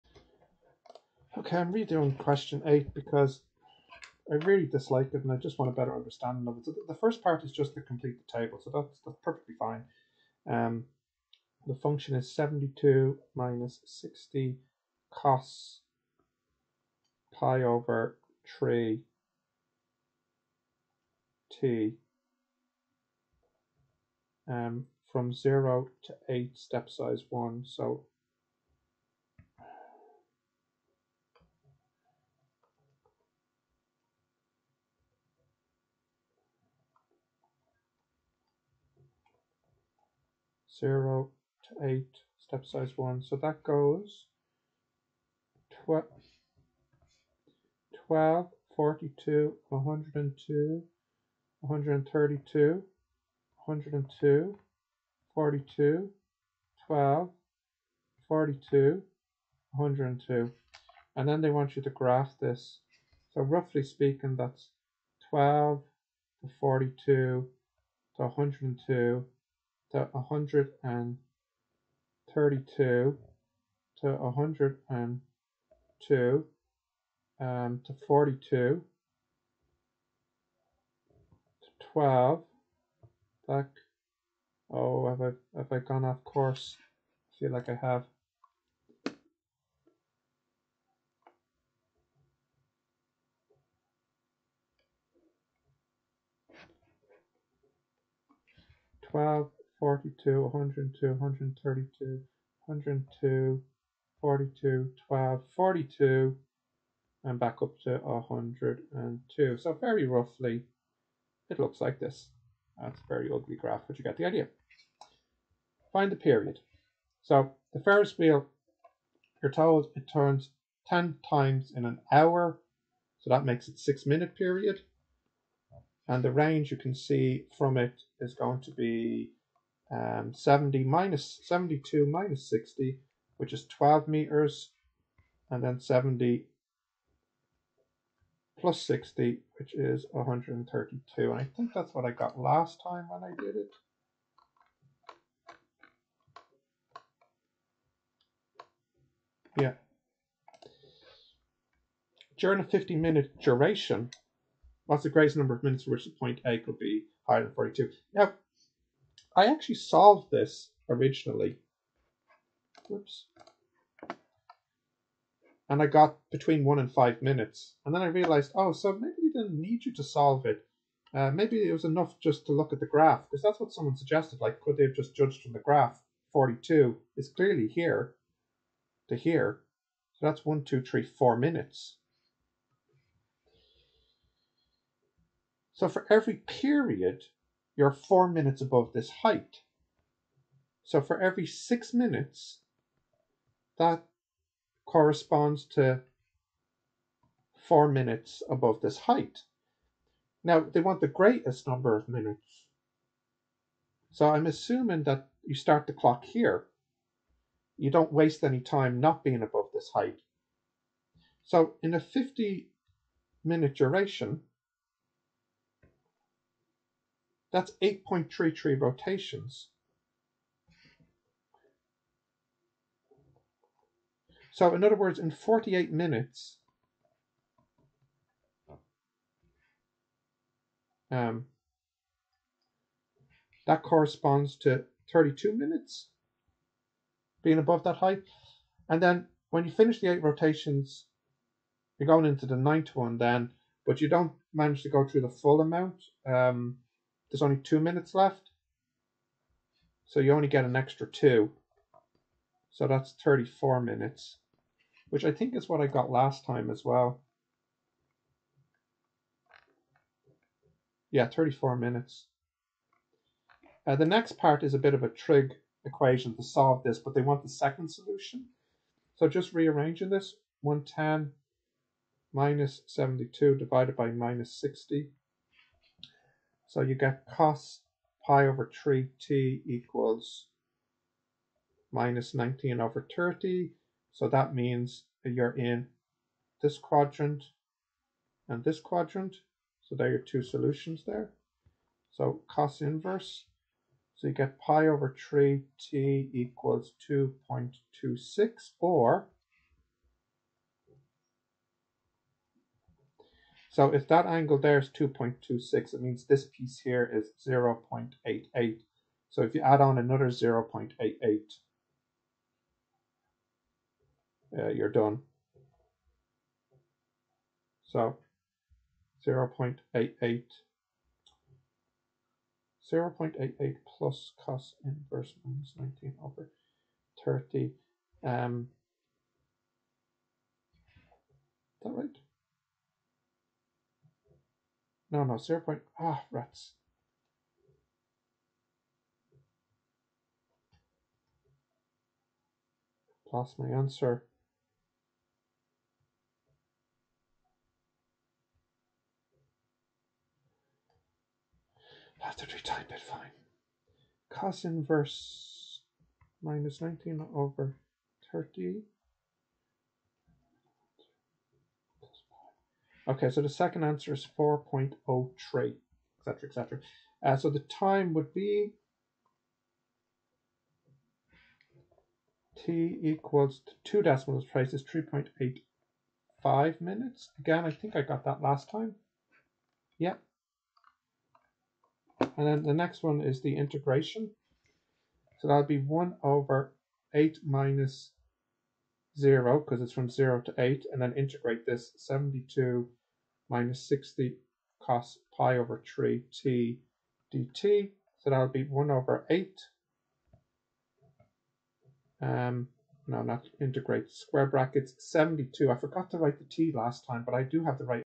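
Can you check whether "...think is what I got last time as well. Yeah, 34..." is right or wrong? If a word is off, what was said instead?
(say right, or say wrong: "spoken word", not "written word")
right.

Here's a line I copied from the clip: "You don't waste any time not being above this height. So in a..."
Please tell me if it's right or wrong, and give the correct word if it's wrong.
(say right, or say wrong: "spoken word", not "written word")
right.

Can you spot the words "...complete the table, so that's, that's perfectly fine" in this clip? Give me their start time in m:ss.
0:07.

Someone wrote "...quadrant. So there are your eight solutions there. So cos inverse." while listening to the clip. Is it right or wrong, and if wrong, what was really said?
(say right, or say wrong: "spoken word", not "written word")
wrong: "two", not "eight".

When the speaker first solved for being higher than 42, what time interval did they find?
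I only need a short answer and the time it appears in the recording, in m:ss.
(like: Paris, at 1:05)
between 1 and 5 minutes, at 2:46.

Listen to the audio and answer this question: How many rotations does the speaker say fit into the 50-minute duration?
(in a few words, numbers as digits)
8.33.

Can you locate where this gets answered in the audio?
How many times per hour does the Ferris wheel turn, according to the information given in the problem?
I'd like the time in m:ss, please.
2:00.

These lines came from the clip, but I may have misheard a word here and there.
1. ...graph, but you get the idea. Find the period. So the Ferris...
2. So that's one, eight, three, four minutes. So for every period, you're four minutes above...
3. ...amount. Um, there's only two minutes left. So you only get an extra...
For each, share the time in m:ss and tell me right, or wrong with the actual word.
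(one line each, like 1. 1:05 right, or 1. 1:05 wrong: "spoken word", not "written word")
1. 1:53 right
2. 3:00 wrong: "two", not "eight"
3. 4:05 right.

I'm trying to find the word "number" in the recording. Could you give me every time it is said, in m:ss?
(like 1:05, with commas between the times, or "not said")
2:35, 3:21.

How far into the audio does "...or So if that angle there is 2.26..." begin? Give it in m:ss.
4:58.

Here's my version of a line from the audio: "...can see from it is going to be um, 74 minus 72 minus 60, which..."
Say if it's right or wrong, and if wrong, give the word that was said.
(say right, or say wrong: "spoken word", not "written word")
wrong: "70", not "74".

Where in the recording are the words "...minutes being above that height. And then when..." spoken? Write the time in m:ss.
3:55.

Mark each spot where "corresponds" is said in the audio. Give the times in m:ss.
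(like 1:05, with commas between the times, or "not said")
3:14, 3:53.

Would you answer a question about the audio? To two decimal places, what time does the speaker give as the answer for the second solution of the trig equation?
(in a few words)
3.85 minutes.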